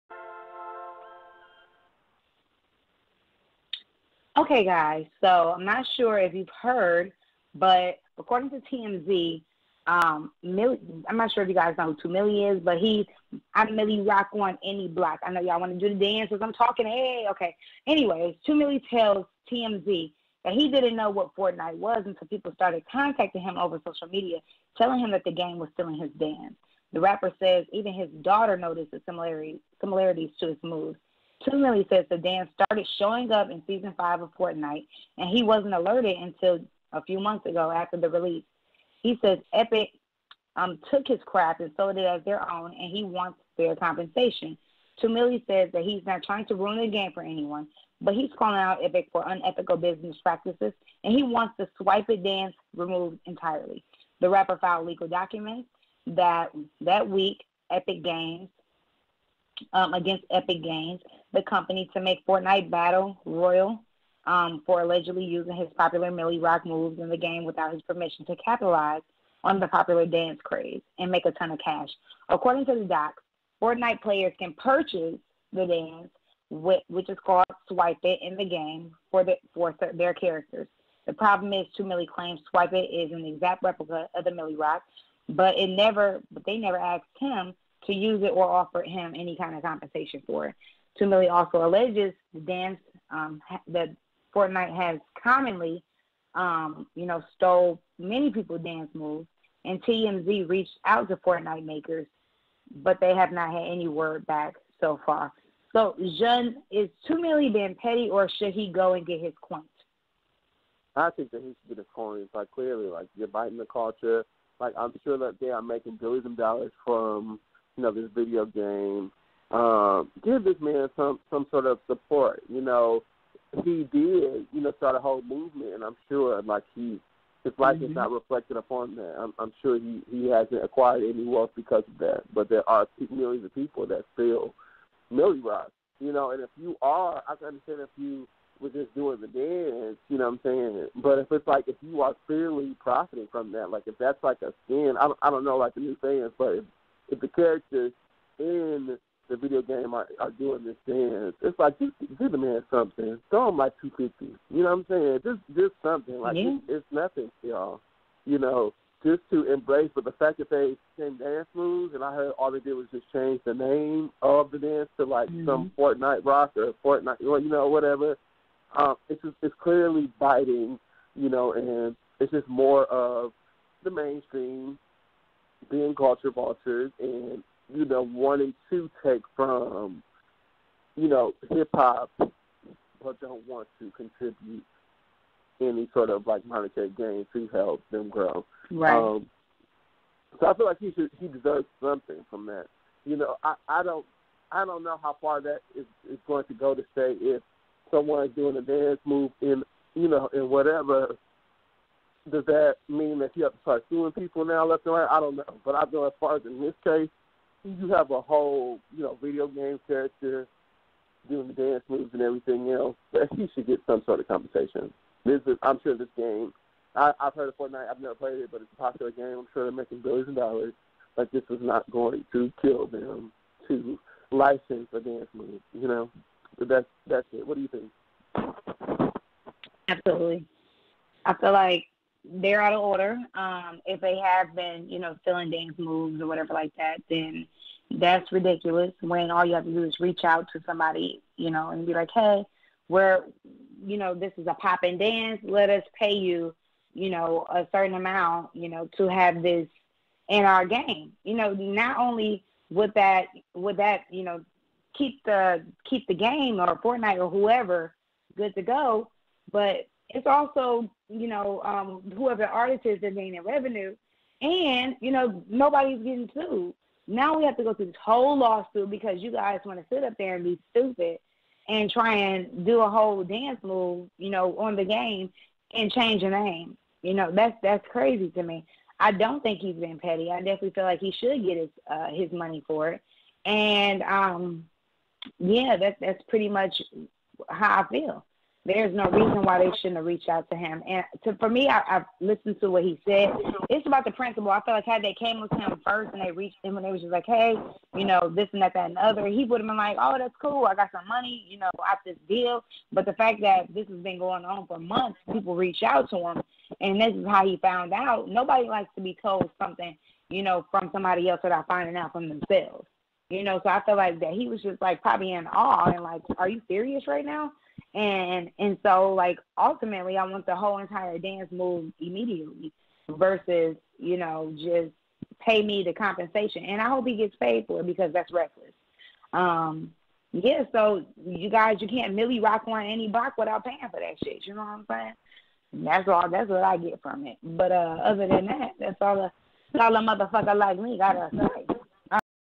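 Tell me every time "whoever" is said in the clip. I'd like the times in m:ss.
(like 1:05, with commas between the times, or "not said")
4:17, 4:22.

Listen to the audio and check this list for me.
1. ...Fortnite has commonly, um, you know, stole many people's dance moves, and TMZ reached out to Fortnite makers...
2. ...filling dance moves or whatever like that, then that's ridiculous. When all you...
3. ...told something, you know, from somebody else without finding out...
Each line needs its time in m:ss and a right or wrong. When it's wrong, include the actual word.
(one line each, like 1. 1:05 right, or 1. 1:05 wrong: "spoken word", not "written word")
1. 1:34 right
2. 3:55 right
3. 5:09 right.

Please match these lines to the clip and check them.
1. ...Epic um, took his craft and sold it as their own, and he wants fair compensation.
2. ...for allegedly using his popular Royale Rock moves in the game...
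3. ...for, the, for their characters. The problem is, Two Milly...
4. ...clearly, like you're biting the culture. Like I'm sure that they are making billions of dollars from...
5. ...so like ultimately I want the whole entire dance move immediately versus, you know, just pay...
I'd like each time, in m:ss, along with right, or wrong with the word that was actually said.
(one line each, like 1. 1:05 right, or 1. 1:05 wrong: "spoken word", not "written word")
1. 0:39 right
2. 1:04 wrong: "Milly", not "Royale"
3. 1:19 right
4. 1:52 right
5. 5:18 right.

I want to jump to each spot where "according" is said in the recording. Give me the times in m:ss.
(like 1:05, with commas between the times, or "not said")
0:08, 1:12.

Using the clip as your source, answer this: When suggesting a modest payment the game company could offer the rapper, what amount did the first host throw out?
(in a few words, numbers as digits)
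250.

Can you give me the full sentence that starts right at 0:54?
The rapper filed legal documents that that week.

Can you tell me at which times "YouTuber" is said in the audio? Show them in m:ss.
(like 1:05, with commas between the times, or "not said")
not said.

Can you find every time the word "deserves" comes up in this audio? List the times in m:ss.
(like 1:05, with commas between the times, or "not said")
3:11.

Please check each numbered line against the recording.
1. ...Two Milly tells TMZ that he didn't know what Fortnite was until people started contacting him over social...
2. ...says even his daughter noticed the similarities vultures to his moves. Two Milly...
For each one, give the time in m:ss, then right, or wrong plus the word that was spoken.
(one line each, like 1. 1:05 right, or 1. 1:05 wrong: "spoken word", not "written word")
1. 0:18 right
2. 0:27 wrong: "similarities", not "vultures".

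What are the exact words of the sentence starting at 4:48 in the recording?
There's no reason why they shouldn't have reached out to him.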